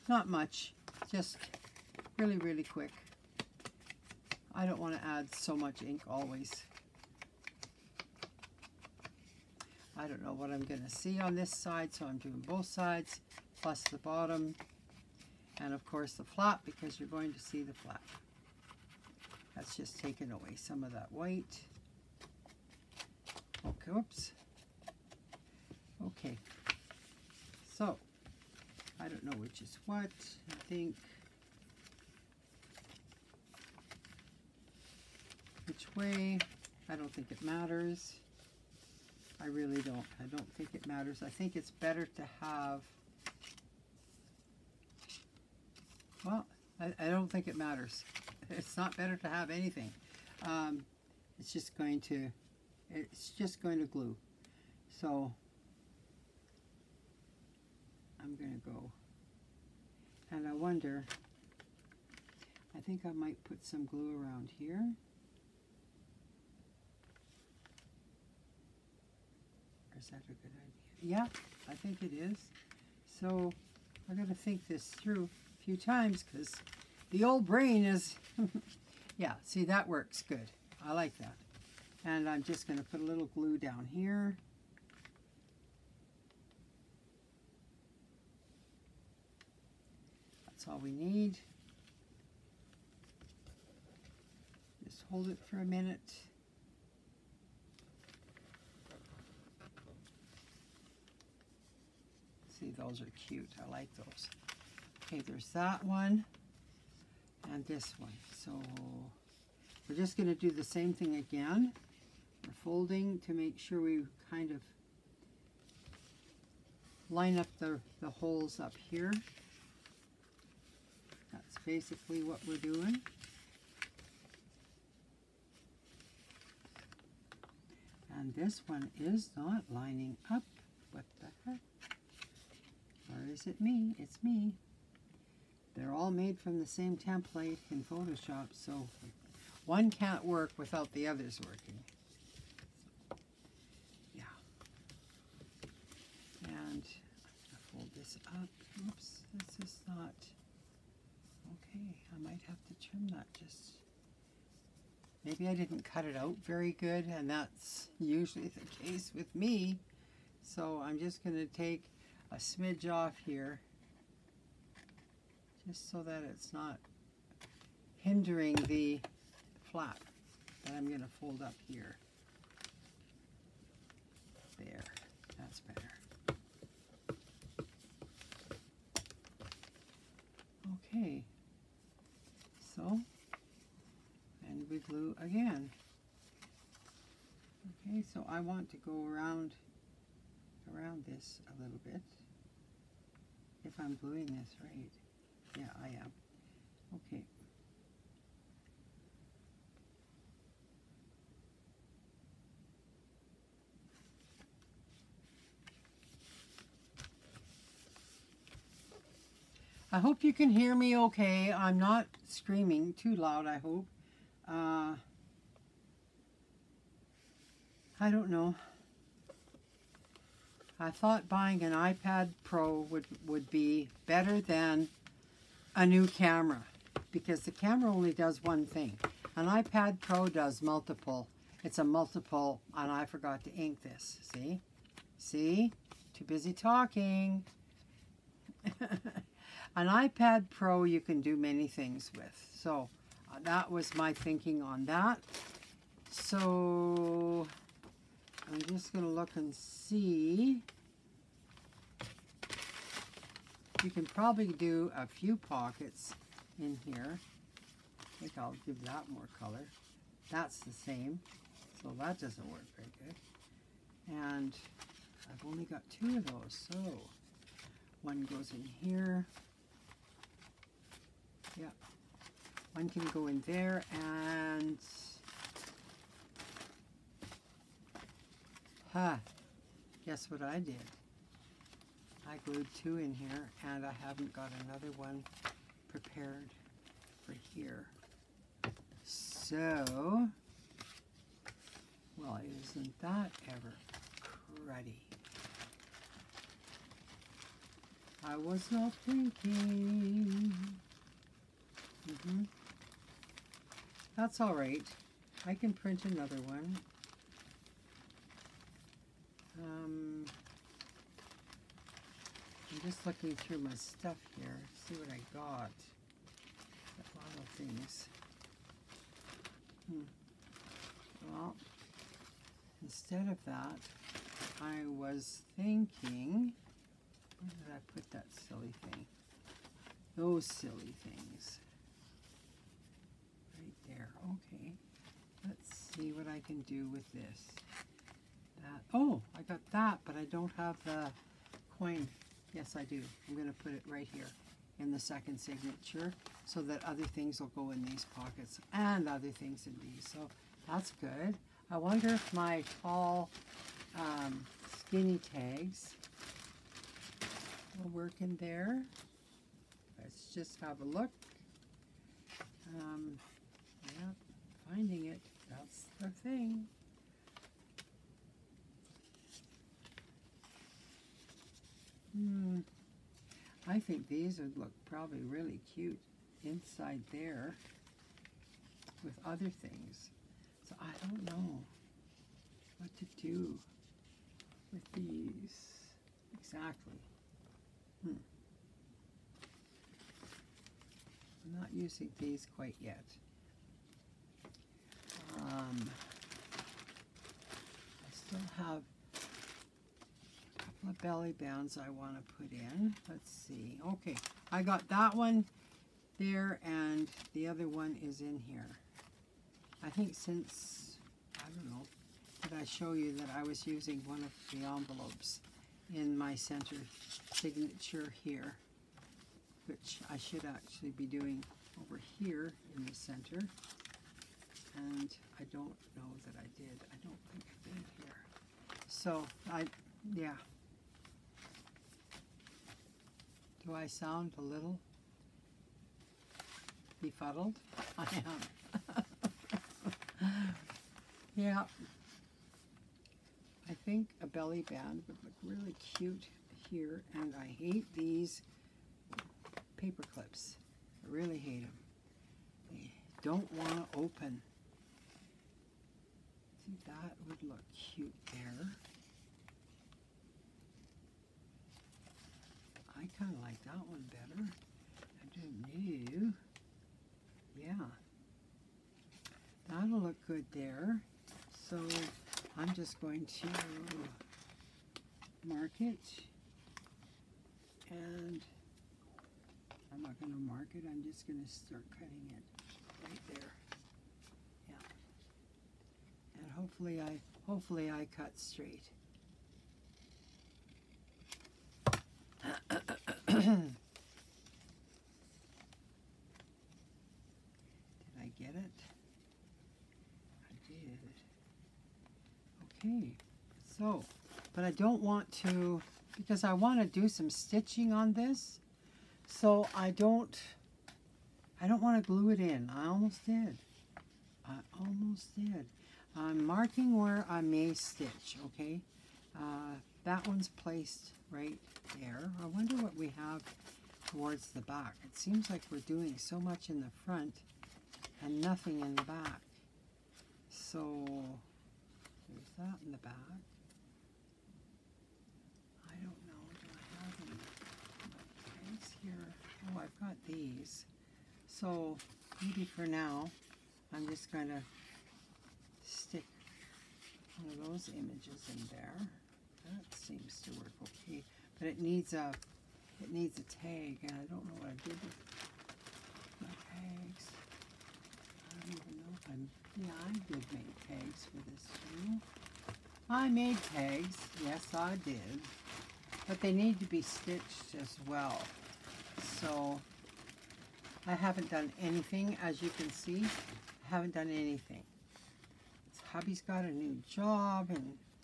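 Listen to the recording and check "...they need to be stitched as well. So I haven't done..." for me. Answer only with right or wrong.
right.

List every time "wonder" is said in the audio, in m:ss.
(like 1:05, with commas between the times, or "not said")
1:00, 5:51, 8:42.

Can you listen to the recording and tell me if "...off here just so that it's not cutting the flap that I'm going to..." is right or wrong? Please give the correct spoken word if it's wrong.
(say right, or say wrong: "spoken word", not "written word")
wrong: "hindering", not "cutting".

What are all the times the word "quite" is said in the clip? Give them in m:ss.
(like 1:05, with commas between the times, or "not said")
6:32.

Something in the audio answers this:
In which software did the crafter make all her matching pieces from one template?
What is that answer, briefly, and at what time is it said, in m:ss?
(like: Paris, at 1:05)
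Photoshop, at 2:17.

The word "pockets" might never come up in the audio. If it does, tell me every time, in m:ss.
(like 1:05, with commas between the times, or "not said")
4:15, 5:48.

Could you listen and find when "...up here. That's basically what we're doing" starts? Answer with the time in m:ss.
1:58.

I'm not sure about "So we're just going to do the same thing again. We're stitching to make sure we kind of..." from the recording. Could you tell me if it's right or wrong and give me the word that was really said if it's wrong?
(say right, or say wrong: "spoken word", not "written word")
wrong: "folding", not "stitching".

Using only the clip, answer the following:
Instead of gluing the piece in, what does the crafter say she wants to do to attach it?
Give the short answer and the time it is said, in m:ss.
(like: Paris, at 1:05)
stitching, at 8:27.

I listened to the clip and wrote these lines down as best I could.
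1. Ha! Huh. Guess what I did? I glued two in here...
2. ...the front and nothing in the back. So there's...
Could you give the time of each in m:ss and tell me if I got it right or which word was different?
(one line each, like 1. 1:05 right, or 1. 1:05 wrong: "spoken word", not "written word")
1. 4:38 right
2. 8:46 right.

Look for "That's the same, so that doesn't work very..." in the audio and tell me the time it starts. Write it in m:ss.
4:20.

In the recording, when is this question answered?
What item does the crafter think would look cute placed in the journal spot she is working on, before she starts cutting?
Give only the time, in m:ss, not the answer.
7:24.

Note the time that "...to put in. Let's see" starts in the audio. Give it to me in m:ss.
6:42.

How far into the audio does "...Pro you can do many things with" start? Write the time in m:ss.
4:00.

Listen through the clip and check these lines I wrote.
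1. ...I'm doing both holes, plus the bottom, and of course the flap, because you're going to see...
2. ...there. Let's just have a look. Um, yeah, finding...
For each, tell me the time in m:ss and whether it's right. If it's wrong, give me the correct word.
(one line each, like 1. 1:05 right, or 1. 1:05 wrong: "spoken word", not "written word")
1. 0:12 wrong: "sides", not "holes"
2. 5:58 right.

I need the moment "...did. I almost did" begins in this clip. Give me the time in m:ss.
8:33.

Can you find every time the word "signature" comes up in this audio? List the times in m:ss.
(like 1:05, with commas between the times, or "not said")
5:45, 6:57.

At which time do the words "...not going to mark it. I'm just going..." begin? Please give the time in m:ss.
8:00.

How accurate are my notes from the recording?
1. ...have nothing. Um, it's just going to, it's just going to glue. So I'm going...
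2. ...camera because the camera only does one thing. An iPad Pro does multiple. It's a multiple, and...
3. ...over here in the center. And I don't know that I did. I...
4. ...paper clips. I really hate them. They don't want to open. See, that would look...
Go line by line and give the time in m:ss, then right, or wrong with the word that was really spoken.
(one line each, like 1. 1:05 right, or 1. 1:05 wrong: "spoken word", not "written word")
1. 0:49 wrong: "anything", not "nothing"
2. 3:46 right
3. 7:01 right
4. 7:29 right.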